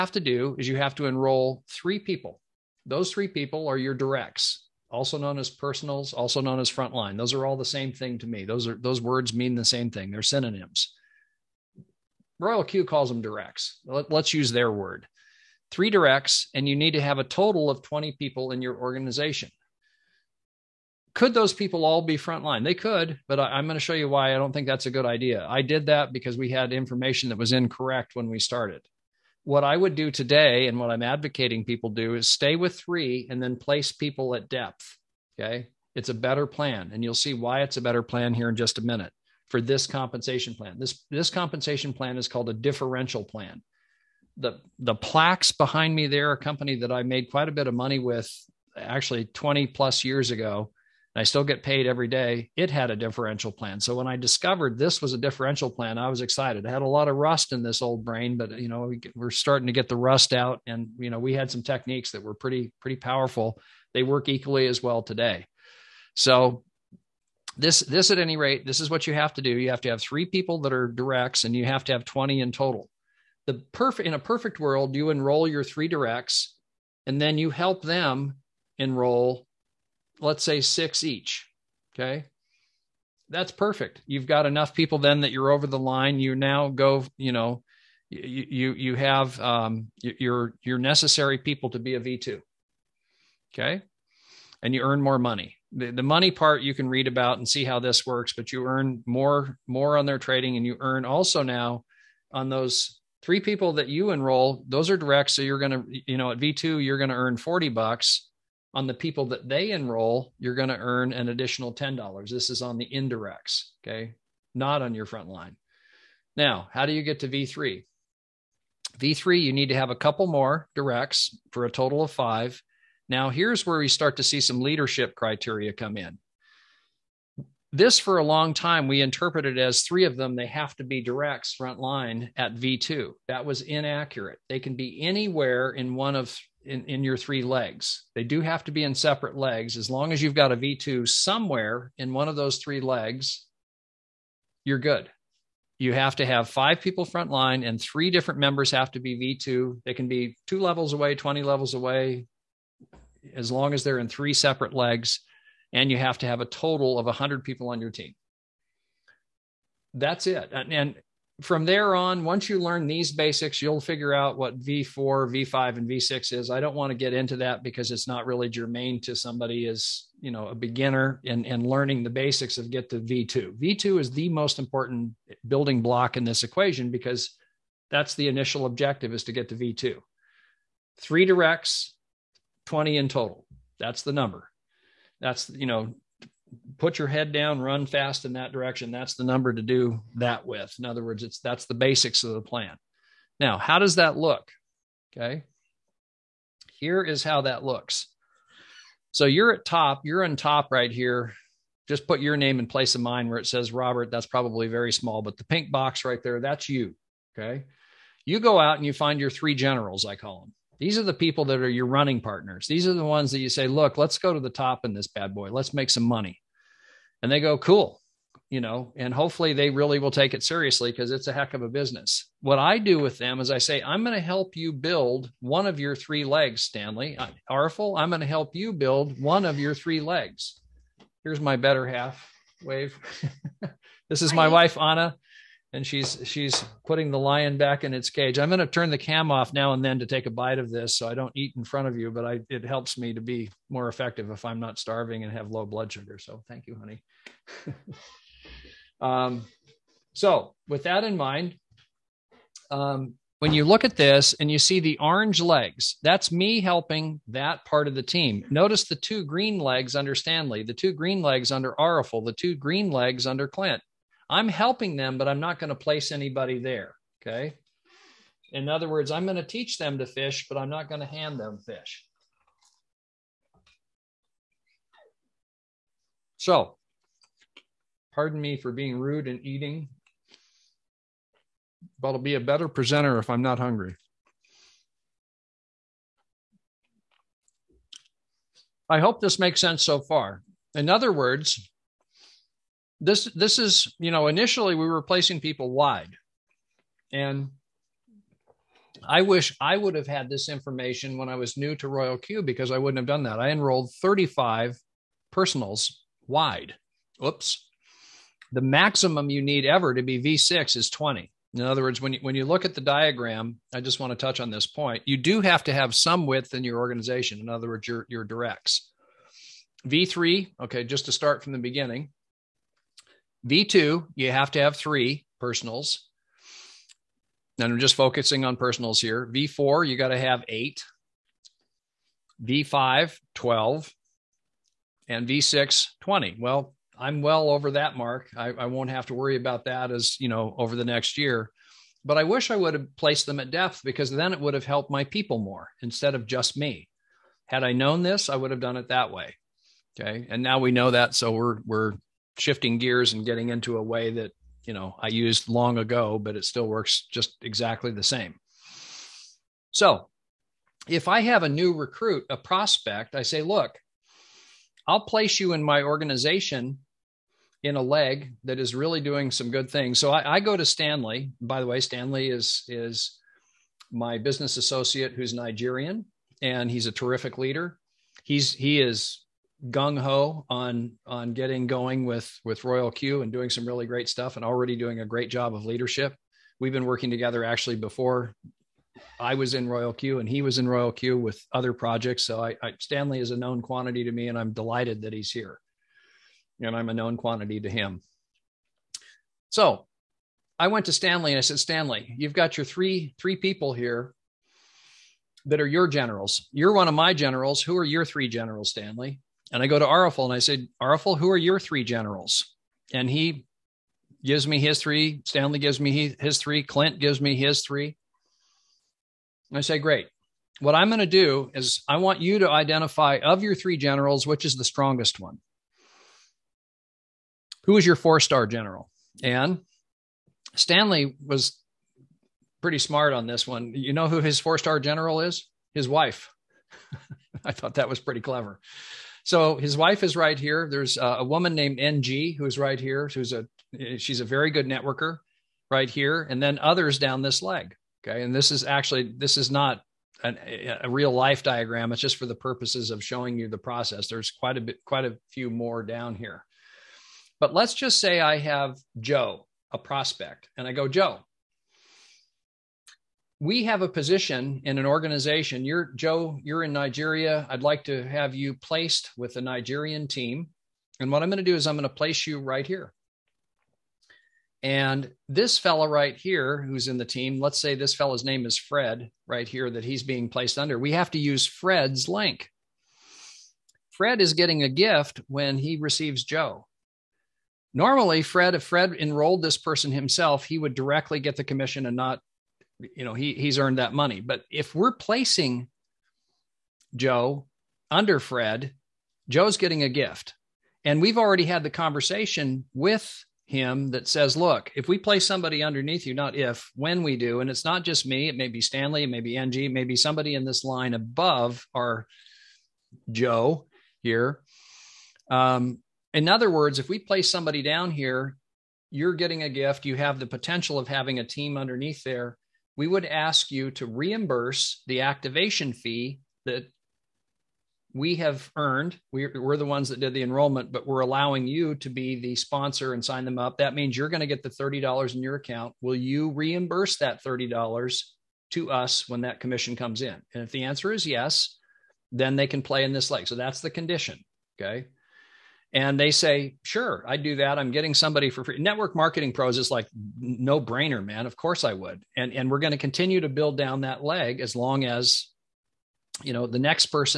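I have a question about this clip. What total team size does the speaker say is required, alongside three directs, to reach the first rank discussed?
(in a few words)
20.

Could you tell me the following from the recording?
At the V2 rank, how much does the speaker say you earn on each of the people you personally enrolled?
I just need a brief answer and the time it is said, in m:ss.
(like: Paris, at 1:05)
$40, at 1:47.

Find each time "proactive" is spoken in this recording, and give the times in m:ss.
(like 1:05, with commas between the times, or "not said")
not said.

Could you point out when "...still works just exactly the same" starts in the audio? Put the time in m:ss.
5:56.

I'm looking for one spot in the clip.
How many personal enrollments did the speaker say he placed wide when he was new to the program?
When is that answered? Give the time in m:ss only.
5:03.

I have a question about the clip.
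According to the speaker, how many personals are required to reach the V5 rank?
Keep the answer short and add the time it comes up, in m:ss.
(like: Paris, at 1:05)
12, at 5:32.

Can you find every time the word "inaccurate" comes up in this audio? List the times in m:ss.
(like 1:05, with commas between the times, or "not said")
2:13.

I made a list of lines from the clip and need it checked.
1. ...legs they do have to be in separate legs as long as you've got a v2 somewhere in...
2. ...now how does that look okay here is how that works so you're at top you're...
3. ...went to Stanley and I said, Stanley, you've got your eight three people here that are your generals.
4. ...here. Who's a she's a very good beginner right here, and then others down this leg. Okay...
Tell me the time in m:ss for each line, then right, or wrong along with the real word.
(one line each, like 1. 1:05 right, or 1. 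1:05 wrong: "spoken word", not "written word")
1. 2:17 right
2. 3:13 wrong: "looks", not "works"
3. 6:40 wrong: "three", not "eight"
4. 7:22 wrong: "networker", not "beginner".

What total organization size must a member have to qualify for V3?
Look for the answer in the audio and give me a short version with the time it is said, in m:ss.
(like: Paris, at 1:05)
100, at 2:36.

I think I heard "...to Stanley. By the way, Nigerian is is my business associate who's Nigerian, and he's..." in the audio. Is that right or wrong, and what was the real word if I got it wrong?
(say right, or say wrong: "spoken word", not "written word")
wrong: "Stanley", not "Nigerian".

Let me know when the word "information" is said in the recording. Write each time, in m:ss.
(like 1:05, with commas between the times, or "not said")
0:26, 5:00.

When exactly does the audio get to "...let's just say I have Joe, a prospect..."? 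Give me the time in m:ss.
7:37.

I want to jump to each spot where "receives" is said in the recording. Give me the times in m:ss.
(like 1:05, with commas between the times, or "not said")
8:05.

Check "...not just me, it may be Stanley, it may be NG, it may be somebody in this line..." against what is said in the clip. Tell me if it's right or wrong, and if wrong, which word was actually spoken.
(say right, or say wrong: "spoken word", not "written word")
right.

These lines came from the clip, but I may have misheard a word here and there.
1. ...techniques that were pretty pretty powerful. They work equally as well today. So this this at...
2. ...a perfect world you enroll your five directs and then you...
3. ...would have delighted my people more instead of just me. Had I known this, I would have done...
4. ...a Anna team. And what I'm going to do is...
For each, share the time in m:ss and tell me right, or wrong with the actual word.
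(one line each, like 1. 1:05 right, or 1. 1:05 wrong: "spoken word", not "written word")
1. 1:01 right
2. 1:14 wrong: "three", not "five"
3. 5:44 wrong: "helped", not "delighted"
4. 7:49 wrong: "Nigerian", not "Anna".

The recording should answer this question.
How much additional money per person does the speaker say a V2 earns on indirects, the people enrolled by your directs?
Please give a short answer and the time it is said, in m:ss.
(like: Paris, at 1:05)
$10, at 1:51.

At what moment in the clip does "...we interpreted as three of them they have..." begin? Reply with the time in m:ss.
2:08.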